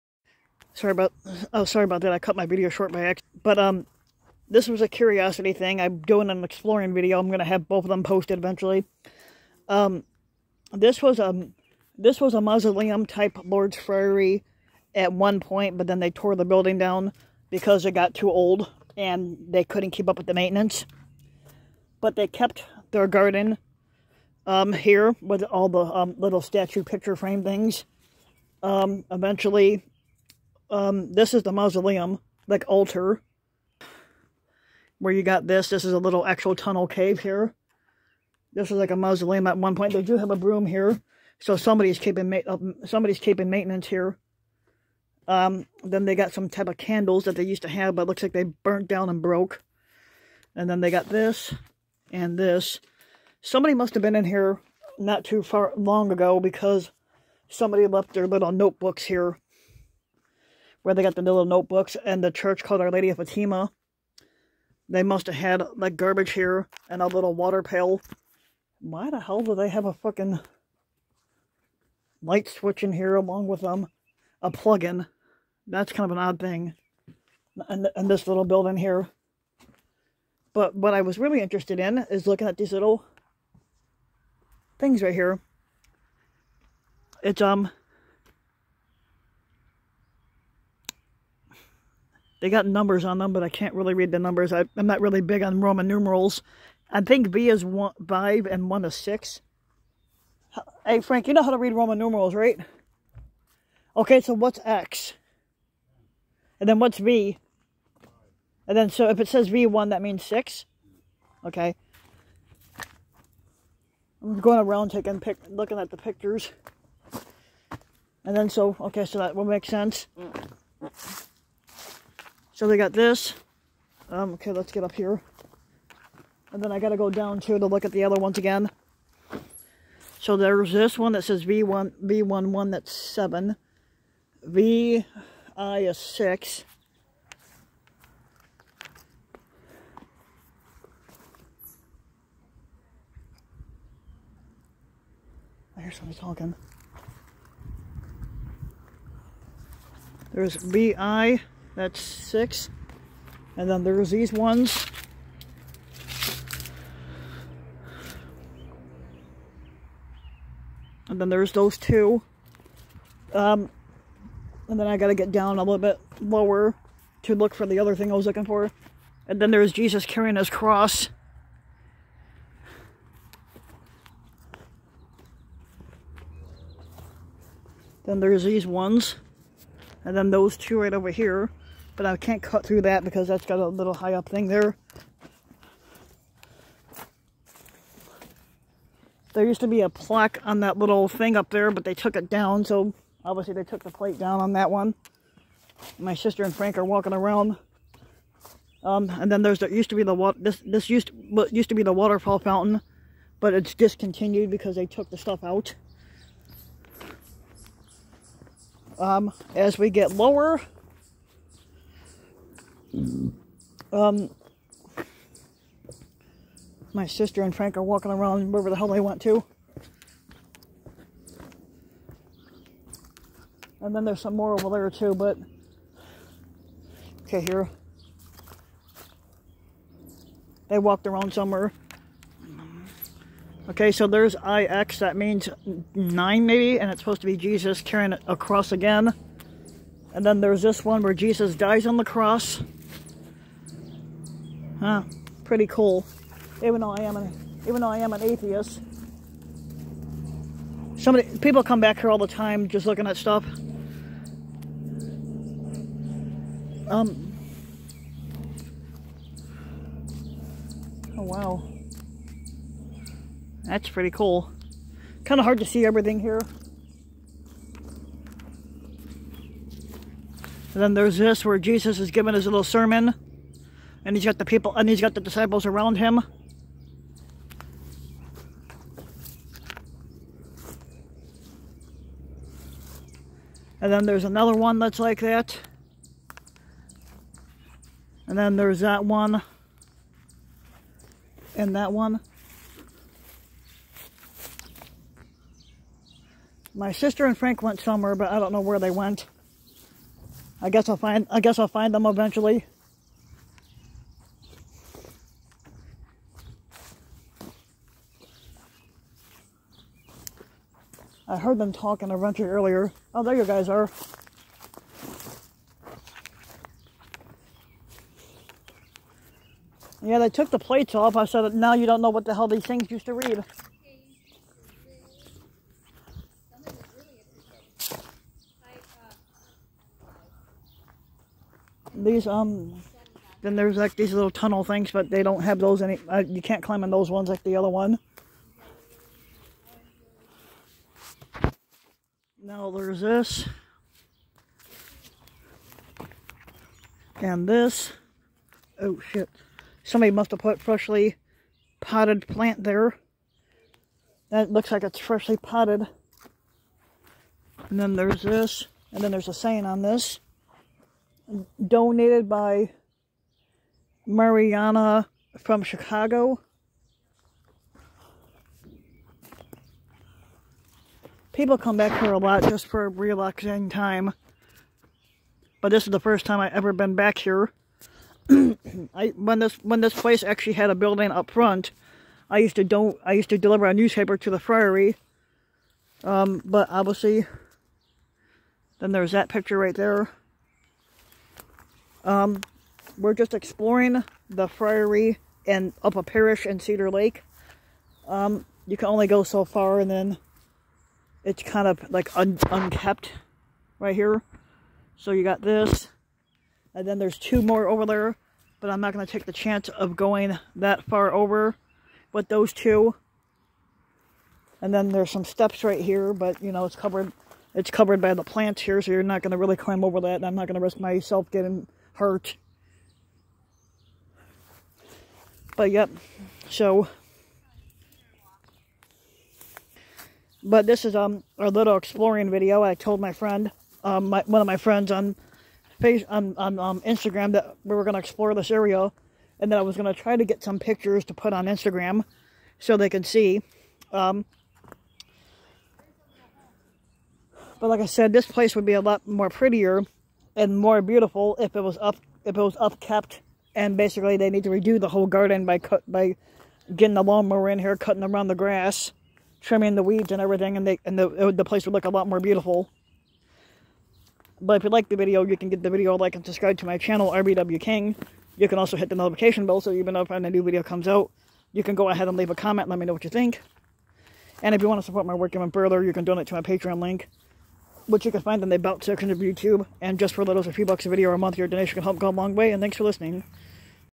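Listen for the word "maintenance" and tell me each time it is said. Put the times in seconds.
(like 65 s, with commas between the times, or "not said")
20 s, 43 s.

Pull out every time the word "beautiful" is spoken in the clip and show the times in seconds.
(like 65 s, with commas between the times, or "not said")
450 s, 462 s.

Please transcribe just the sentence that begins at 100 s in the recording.
Hey, Frank, you know how to read Roman numerals, right?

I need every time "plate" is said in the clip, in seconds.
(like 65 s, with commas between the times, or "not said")
193 s, 320 s.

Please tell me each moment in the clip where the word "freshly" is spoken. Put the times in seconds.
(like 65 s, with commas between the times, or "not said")
350 s, 354 s.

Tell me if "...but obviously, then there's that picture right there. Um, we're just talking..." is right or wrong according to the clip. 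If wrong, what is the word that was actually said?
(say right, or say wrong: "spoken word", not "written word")
wrong: "exploring", not "talking".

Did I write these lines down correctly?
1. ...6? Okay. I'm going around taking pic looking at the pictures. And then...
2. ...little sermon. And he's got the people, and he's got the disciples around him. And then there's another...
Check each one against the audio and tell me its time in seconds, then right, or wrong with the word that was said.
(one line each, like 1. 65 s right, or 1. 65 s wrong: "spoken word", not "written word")
1. 110 s right
2. 272 s right.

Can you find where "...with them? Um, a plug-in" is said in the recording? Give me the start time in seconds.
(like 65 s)
73 s.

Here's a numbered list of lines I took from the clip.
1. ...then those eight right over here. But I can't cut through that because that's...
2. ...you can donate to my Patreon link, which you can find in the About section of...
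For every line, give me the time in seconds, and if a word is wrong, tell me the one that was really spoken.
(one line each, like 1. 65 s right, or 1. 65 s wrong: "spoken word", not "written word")
1. 180 s wrong: "two", not "eight"
2. 475 s right.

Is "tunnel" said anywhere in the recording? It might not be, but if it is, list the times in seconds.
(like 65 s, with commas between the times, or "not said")
36 s, 334 s.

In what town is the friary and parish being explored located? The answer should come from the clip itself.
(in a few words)
Cedar Lake.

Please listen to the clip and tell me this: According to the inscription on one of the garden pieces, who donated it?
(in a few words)
Mariana from Chicago.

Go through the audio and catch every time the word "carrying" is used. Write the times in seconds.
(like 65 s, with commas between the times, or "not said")
170 s, 237 s.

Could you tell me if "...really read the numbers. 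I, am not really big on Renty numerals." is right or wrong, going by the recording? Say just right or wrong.
wrong.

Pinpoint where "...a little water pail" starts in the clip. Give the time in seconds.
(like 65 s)
67 s.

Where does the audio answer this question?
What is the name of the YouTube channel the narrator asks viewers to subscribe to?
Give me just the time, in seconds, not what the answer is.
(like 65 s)
467 s.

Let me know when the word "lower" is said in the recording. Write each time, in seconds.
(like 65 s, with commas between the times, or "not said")
166 s, 210 s.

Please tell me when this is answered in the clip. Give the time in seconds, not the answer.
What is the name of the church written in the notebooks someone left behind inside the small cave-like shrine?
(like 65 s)
62 s.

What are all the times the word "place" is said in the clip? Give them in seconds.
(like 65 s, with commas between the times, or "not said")
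379 s, 448 s, 461 s.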